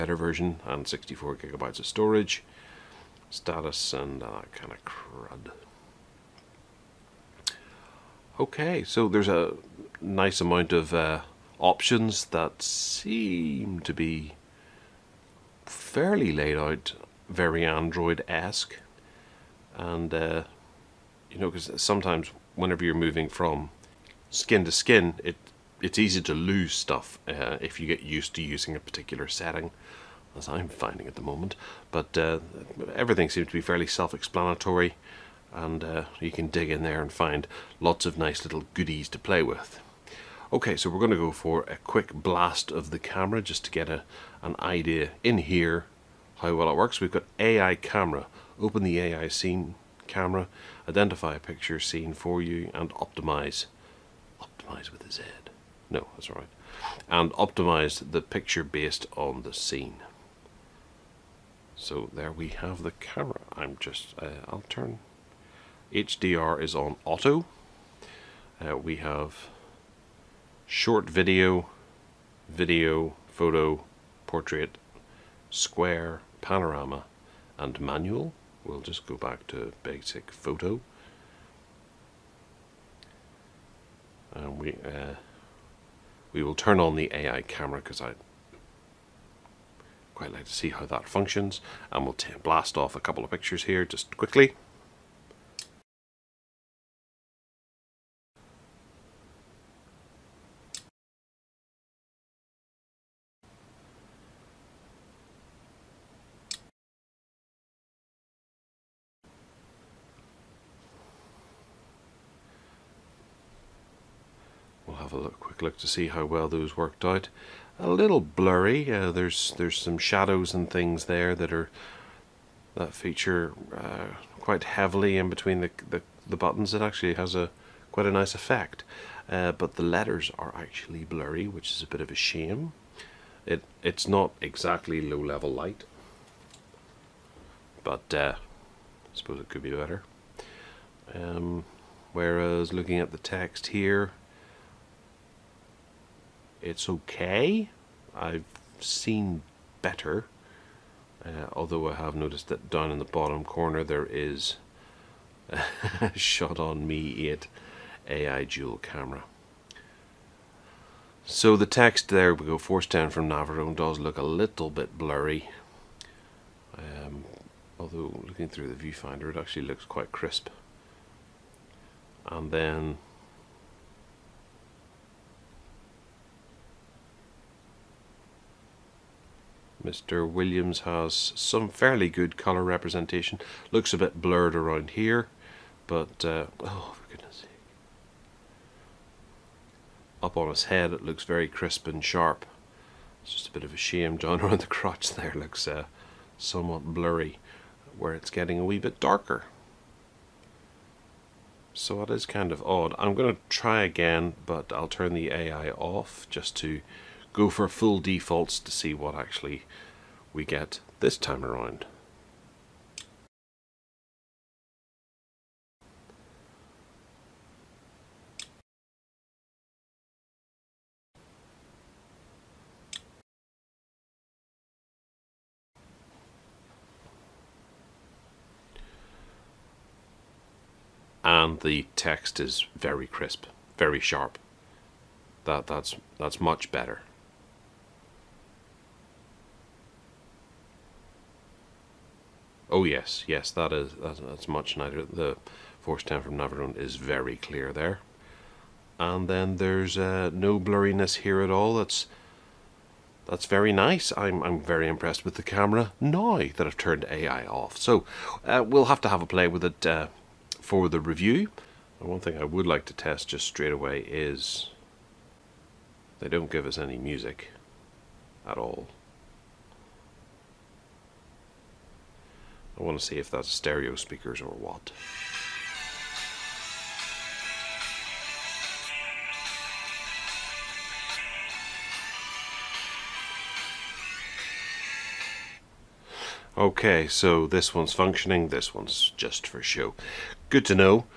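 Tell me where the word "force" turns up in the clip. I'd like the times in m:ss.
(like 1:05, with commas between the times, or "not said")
2:42, 4:05.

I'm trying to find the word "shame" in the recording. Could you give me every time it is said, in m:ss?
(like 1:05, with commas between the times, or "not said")
2:12, 3:13.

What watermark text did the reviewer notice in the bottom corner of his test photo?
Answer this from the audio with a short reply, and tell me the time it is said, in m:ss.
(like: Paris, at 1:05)
Shot on Mi 8 AI dual camera, at 2:36.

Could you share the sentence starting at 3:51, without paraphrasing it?
and the text is very crisp, very sharp.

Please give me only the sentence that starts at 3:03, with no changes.
Looks a bit blurred around here, but uh, oh, for goodness sake.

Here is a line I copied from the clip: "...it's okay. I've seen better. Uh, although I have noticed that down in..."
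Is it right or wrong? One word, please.
right.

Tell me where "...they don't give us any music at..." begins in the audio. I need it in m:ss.
4:26.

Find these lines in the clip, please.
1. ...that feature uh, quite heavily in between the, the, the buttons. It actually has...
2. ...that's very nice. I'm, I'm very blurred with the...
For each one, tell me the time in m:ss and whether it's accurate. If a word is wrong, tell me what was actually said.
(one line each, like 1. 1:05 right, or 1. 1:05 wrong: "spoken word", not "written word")
1. 2:02 right
2. 4:13 wrong: "impressed", not "blurred".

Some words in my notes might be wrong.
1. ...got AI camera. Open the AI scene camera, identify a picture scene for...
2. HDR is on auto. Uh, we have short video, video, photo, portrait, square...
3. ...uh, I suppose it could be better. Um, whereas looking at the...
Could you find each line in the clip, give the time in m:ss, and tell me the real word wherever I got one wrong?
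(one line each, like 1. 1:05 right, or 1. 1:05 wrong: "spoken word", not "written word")
1. 0:47 right
2. 1:05 right
3. 2:18 right.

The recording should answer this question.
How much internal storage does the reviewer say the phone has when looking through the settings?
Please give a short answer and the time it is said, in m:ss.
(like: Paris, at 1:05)
64 GB, at 0:00.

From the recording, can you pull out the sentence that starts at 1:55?
have a look, quick look to see how well those worked out.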